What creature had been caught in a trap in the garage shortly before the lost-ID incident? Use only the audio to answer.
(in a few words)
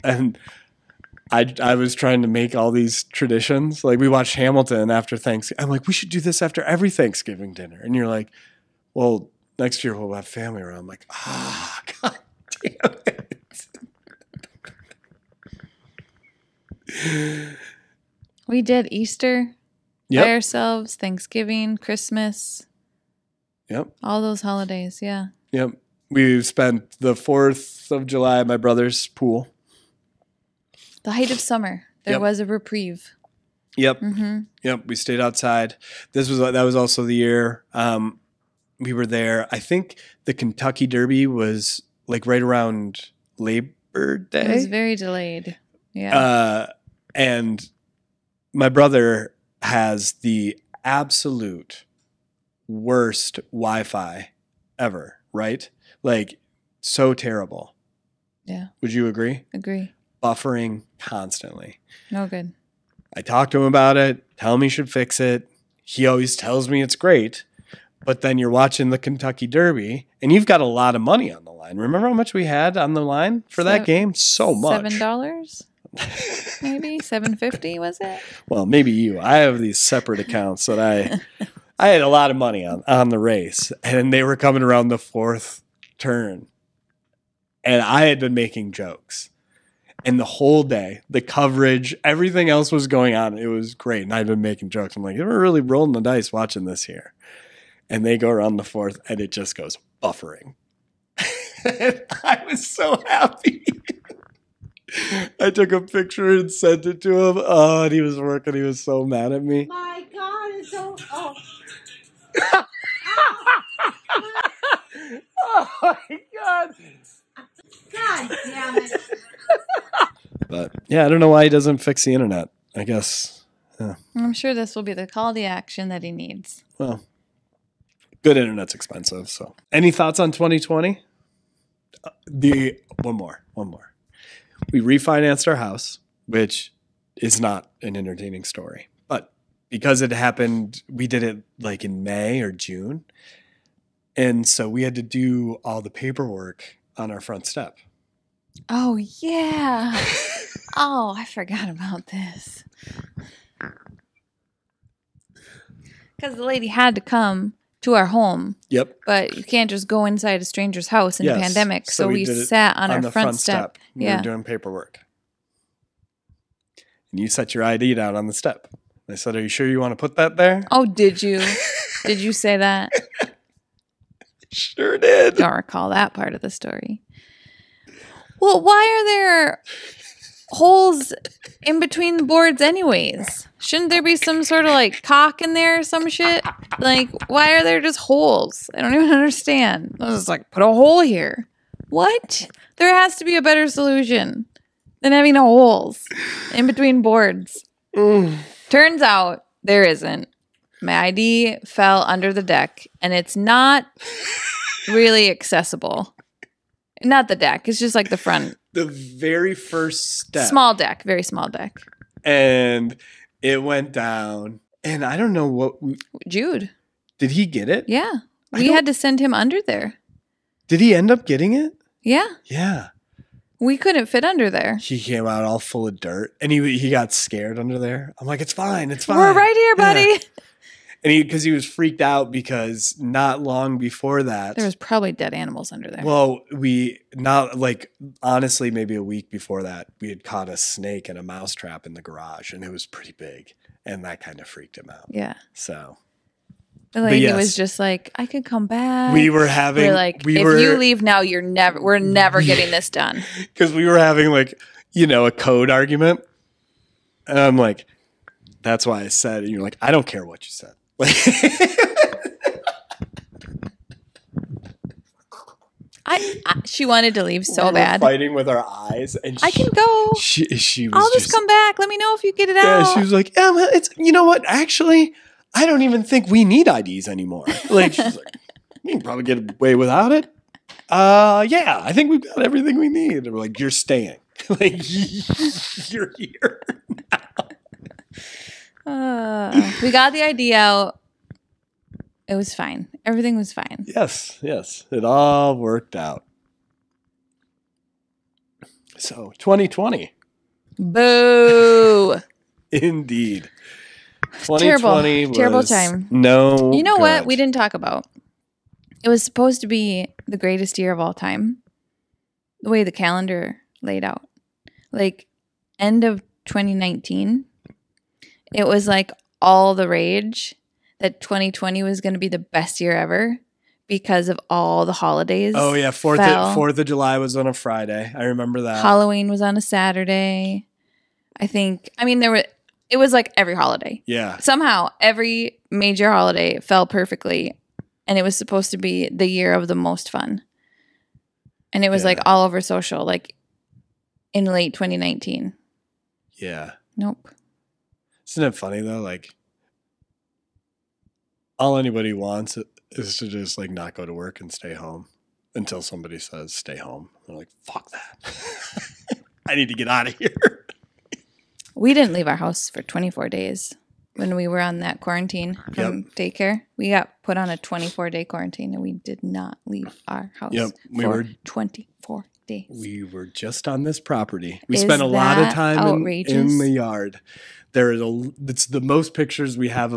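A snake.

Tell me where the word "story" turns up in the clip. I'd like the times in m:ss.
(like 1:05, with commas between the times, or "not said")
2:18, 2:56.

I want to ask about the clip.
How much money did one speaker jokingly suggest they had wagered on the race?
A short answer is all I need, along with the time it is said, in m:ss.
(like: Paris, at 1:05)
$7, at 1:14.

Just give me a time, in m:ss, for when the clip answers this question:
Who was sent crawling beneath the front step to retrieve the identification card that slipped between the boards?
3:36.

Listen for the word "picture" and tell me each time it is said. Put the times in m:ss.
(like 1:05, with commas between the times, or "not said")
1:45, 6:19.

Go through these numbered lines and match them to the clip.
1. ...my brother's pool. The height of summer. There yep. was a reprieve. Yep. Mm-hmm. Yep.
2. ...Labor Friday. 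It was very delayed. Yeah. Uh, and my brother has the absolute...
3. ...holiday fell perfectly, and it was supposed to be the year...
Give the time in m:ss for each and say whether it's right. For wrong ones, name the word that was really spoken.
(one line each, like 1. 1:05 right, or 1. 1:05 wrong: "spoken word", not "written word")
1. 0:28 right
2. 0:43 wrong: "Day", not "Friday"
3. 5:36 right.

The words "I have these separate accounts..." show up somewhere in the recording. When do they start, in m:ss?
1:19.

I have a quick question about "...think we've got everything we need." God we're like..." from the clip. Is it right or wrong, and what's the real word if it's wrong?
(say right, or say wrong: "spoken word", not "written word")
wrong: "And", not "God".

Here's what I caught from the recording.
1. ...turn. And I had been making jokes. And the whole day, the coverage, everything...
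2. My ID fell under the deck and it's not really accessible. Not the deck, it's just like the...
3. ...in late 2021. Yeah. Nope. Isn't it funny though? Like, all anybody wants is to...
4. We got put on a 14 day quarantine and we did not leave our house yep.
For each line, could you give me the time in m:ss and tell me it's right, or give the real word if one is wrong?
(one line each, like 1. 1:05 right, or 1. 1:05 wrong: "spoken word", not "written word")
1. 1:25 right
2. 3:20 right
3. 5:44 wrong: "2019", not "2021"
4. 6:06 wrong: "24", not "14".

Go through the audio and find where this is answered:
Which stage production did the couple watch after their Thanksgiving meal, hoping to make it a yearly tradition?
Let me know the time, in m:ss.
0:04.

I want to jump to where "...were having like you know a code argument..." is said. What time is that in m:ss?
4:13.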